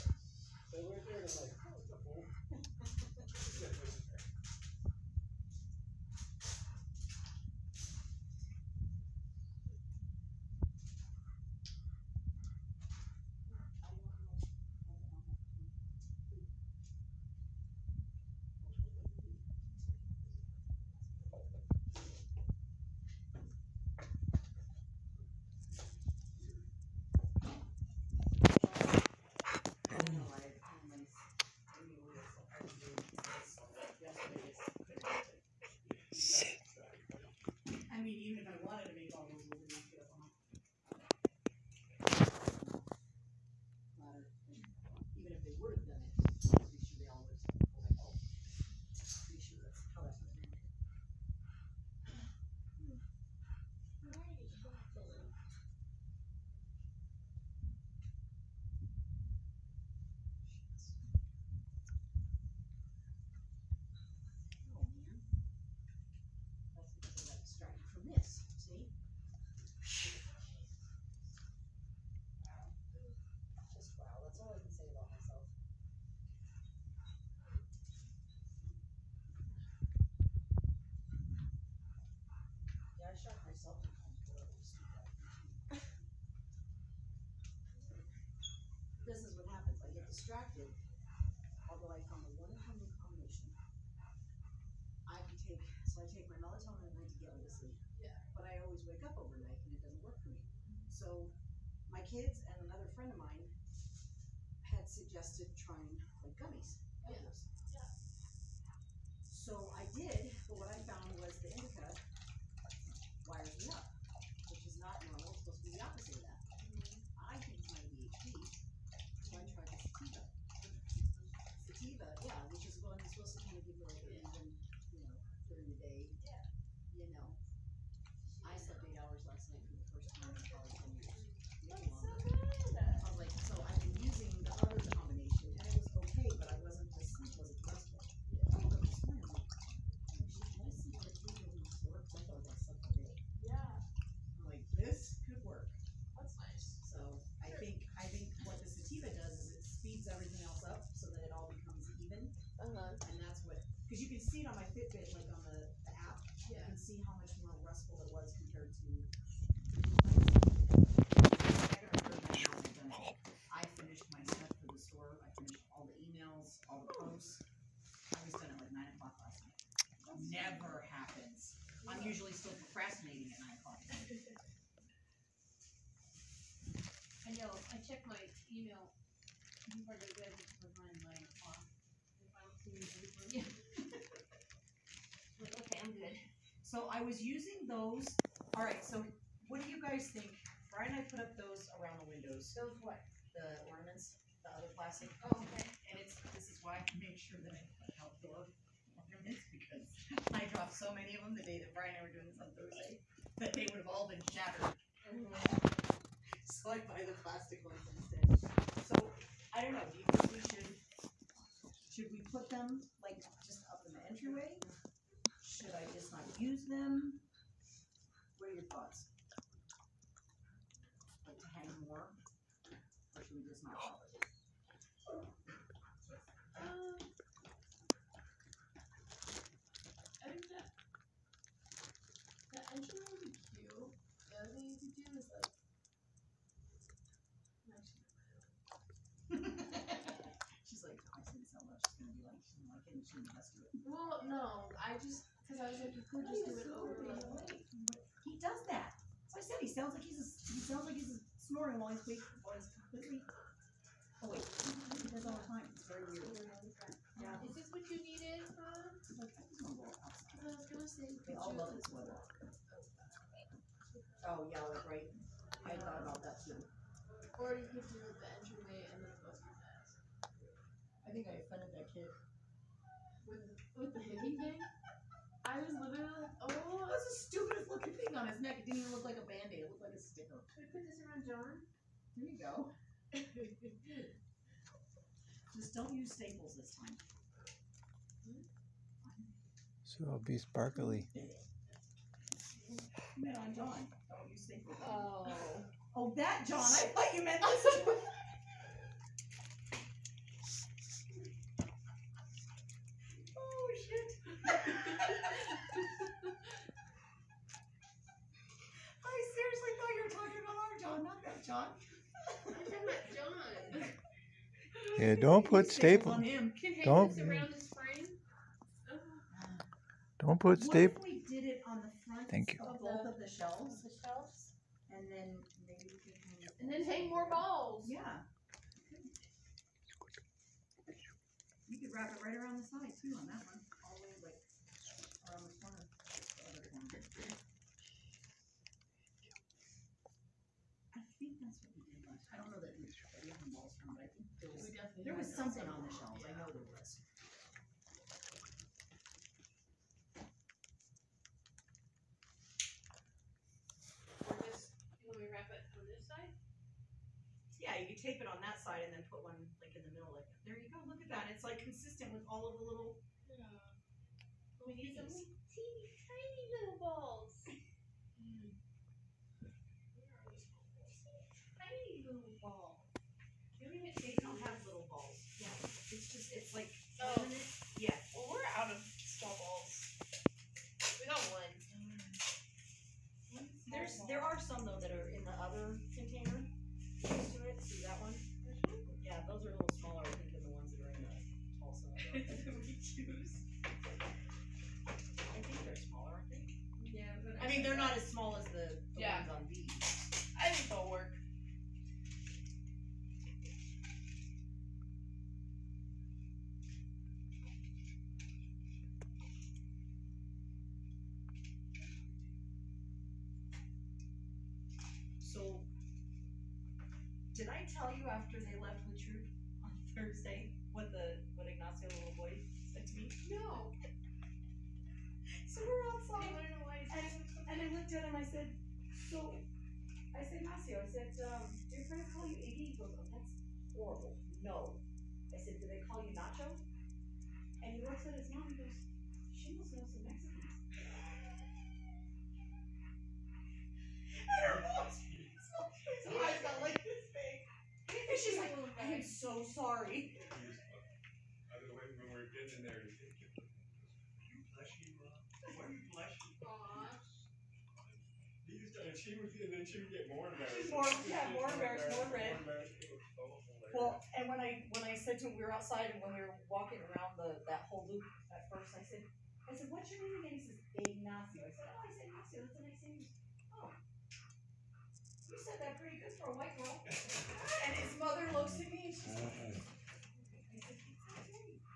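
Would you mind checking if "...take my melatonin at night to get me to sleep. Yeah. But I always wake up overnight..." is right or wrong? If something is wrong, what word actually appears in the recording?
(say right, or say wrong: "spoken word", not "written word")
right.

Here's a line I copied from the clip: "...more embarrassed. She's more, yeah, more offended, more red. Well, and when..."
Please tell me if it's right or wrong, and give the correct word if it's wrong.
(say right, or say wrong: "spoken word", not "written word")
wrong: "embarrassed", not "offended".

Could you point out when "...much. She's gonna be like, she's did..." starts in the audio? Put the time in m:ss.
4:01.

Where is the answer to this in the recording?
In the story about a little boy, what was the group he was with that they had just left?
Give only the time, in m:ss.
6:58.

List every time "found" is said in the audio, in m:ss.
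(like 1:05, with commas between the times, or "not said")
1:32, 1:50.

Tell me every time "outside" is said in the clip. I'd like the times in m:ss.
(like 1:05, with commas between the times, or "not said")
7:05, 7:45.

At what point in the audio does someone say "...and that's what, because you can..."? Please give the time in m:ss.
2:33.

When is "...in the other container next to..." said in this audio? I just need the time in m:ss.
6:25.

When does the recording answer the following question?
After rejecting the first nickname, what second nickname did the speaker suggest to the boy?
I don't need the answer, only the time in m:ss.
7:16.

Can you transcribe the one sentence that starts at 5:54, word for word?
Or this, wrap it on this side?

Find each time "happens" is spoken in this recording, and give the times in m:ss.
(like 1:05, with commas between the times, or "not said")
1:29, 2:50.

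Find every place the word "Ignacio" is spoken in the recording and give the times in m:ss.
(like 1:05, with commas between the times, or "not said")
7:01, 7:10, 7:50.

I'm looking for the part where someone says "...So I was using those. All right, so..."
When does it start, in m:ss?
3:06.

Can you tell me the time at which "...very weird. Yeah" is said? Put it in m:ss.
4:15.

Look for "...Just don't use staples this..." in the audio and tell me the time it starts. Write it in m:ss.
4:45.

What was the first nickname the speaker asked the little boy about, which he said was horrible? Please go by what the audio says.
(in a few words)
Iggy.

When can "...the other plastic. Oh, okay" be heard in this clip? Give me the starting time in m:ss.
3:14.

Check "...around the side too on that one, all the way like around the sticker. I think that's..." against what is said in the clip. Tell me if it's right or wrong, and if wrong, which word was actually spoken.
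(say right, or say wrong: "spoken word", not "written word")
wrong: "corner", not "sticker".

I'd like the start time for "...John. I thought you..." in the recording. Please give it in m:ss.
4:56.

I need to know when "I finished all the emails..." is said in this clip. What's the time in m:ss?
2:45.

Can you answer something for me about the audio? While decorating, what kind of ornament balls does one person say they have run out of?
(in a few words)
straw balls.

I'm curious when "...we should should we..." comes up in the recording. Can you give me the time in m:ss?
3:30.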